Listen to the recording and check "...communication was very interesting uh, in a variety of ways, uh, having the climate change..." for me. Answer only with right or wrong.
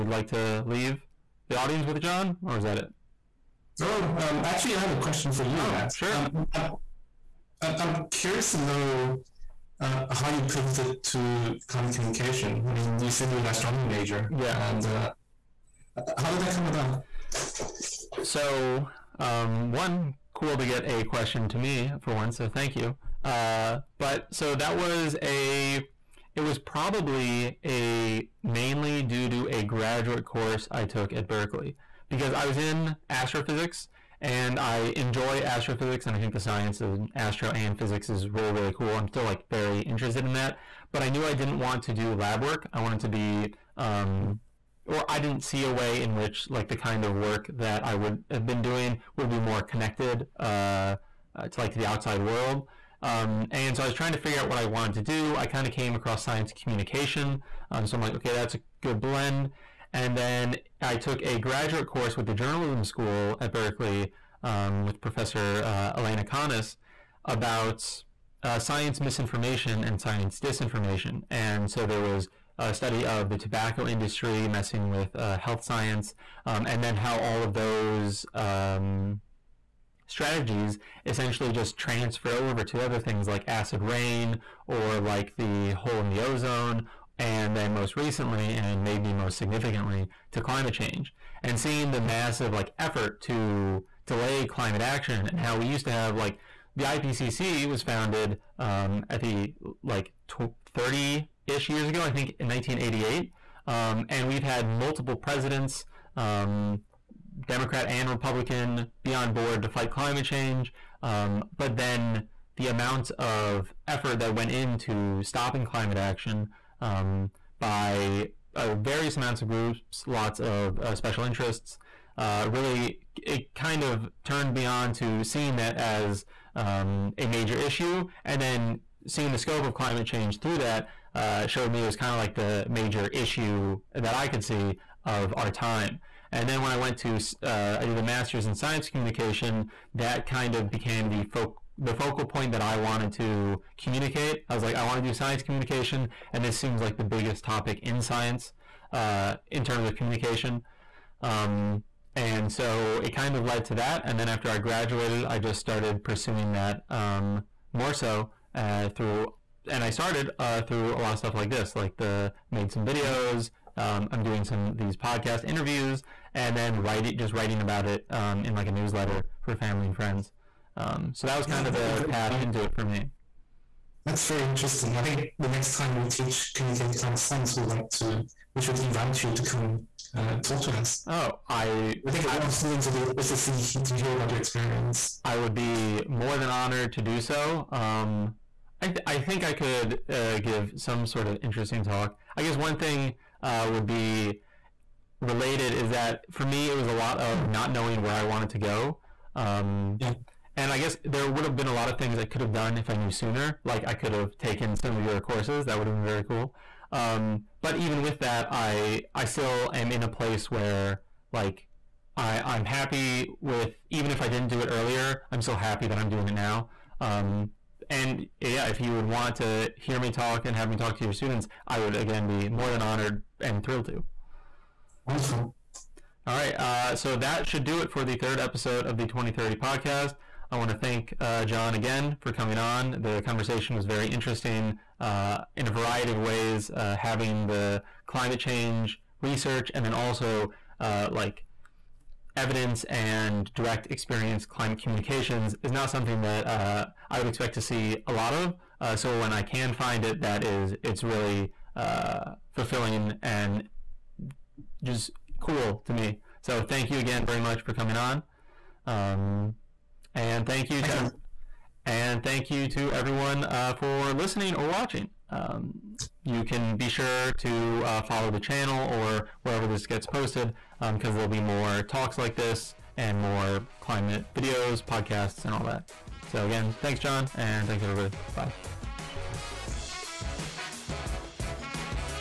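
wrong.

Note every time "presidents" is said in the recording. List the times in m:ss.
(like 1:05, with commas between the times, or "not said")
1:45.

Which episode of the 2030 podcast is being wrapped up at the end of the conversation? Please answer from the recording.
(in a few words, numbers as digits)
third.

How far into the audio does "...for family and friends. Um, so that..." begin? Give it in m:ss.
2:49.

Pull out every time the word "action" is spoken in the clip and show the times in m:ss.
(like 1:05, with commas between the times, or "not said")
1:34, 1:55.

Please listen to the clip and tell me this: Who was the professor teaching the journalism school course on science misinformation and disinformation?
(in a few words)
Elena Conis.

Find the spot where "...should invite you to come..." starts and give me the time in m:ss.
2:58.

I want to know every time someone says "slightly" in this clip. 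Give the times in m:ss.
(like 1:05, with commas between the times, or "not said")
not said.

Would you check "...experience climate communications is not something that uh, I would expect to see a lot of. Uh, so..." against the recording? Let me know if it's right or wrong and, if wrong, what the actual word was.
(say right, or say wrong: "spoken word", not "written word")
right.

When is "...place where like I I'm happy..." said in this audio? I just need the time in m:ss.
3:30.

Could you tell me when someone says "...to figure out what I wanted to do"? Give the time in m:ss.
0:54.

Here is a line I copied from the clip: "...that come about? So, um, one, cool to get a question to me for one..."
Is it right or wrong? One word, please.
right.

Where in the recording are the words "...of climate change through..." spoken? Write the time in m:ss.
2:09.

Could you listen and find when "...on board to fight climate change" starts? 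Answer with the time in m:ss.
1:49.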